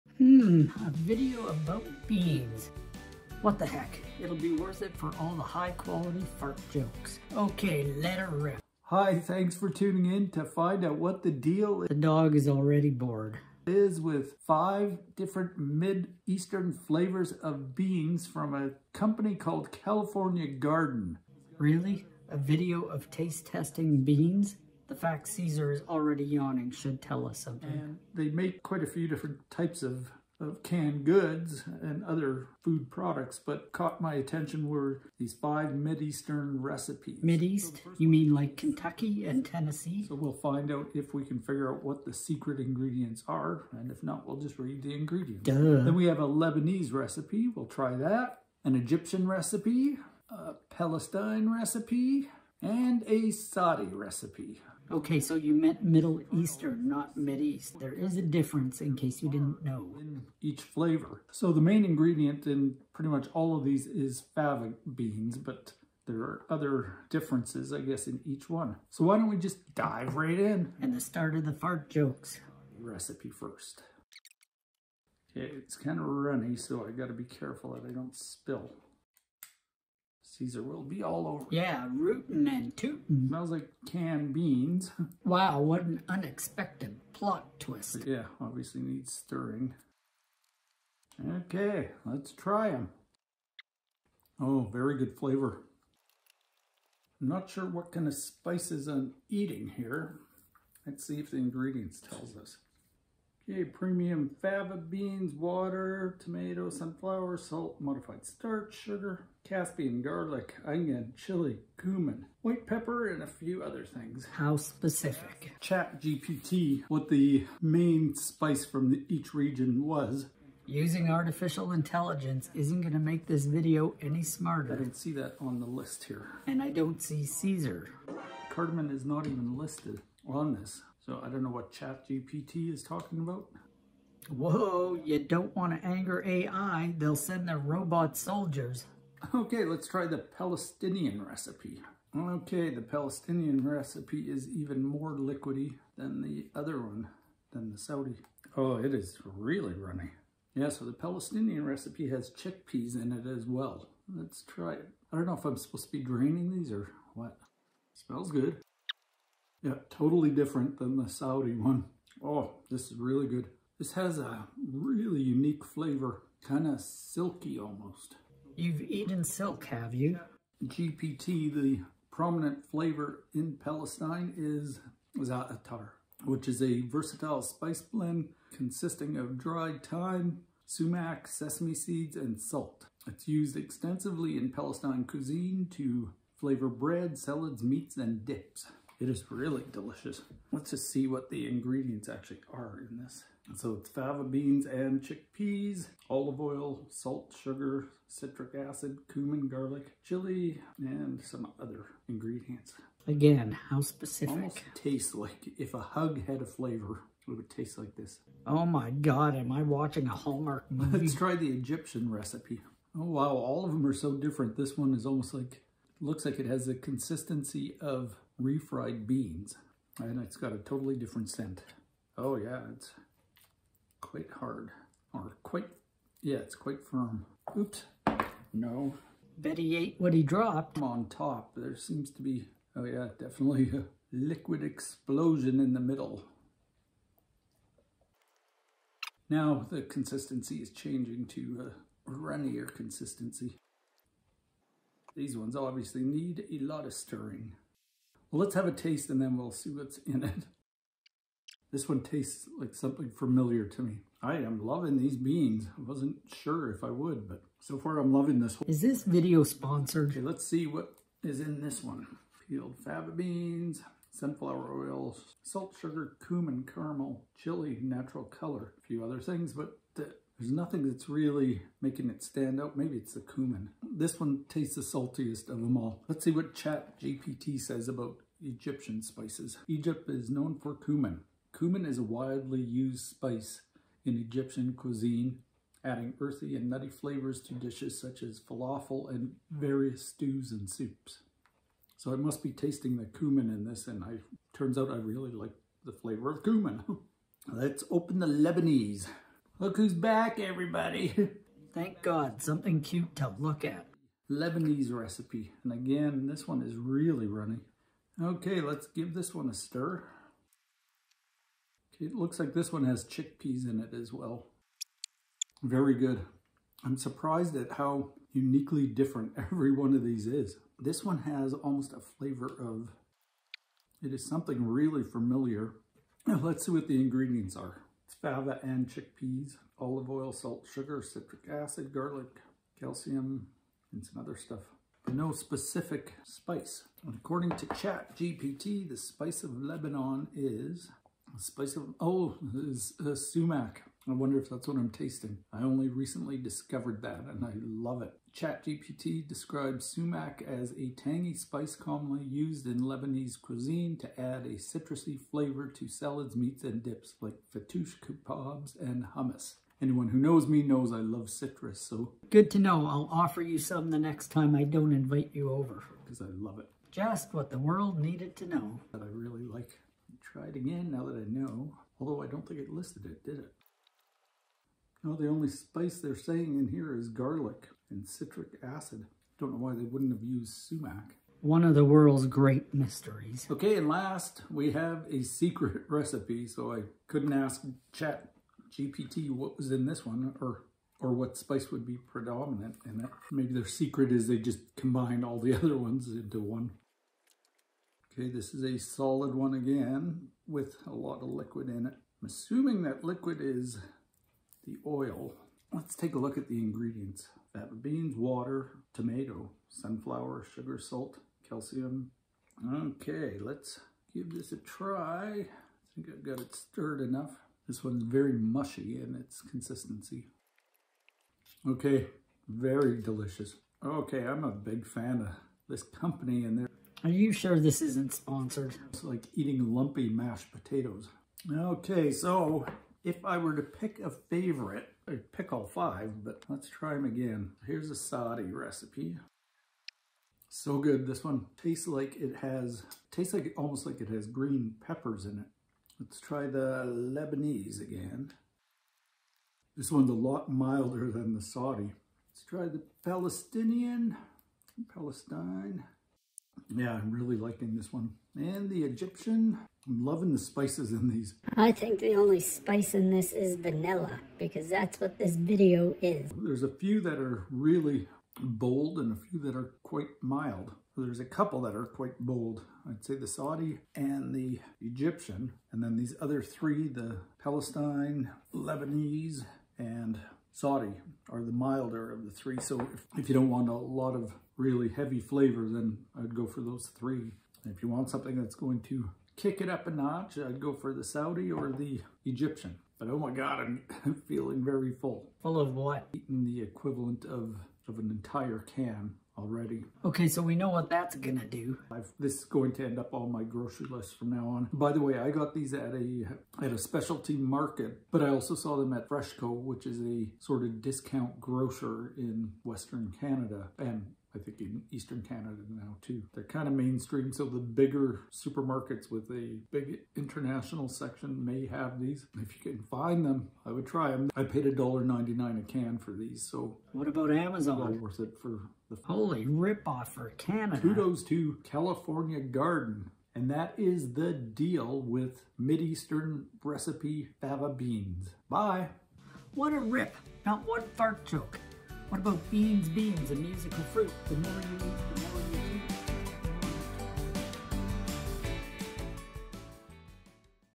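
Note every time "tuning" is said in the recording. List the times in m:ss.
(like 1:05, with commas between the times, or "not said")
0:09.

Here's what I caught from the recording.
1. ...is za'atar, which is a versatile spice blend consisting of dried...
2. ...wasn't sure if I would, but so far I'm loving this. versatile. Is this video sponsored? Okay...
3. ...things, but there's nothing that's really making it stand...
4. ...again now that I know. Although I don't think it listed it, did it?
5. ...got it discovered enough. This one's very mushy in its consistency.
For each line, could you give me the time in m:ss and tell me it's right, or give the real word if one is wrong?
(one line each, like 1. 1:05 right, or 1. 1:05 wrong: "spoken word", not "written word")
1. 2:54 right
2. 4:15 wrong: "whole", not "versatile"
3. 4:29 right
4. 6:10 right
5. 6:56 wrong: "stirred", not "discovered".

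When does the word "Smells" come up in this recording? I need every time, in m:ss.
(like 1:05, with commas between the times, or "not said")
1:23, 2:37.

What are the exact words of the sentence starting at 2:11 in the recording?
So I don't know what ChatGPT is talking about.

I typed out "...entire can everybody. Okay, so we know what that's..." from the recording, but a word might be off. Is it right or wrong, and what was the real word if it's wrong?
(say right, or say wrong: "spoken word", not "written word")
wrong: "already", not "everybody".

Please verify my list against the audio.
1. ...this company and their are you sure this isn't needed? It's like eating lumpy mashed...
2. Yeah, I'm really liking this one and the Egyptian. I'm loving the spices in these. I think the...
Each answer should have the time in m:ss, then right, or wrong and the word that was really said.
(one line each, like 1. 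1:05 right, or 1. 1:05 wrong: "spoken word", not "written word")
1. 7:05 wrong: "sponsored", not "needed"
2. 7:36 right.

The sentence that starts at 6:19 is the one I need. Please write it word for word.
Don't know why they wouldn't have used sumac.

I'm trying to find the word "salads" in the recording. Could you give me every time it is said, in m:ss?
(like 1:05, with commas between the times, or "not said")
3:07, 5:55.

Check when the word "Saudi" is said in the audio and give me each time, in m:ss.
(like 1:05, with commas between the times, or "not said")
0:53, 2:27, 2:41, 7:17, 7:31, 7:53, 8:00, 8:11.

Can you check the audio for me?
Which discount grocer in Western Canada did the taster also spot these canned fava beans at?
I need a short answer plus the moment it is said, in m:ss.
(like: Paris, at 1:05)
Freshco, at 8:29.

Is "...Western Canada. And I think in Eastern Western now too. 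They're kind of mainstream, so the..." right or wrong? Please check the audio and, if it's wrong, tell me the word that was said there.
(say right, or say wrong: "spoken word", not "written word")
wrong: "Canada", not "Western".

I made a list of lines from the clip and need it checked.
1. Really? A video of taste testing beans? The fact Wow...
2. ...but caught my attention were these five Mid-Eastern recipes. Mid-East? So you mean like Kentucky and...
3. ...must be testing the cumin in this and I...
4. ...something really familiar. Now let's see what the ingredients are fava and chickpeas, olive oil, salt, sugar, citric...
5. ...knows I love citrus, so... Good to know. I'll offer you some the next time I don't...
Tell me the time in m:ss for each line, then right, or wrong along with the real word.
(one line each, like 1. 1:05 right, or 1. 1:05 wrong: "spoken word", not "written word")
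1. 0:21 wrong: "Caesar", not "Wow"
2. 0:33 right
3. 4:52 wrong: "tasting", not "testing"
4. 5:24 right
5. 6:00 right.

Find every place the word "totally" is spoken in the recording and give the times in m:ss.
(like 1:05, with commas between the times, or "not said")
2:39, 3:40.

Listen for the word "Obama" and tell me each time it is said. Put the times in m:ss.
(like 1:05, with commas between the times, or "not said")
not said.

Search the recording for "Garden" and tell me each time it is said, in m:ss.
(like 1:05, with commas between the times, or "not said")
0:20, 8:52.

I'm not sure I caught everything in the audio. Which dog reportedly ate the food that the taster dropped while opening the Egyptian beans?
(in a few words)
Betty.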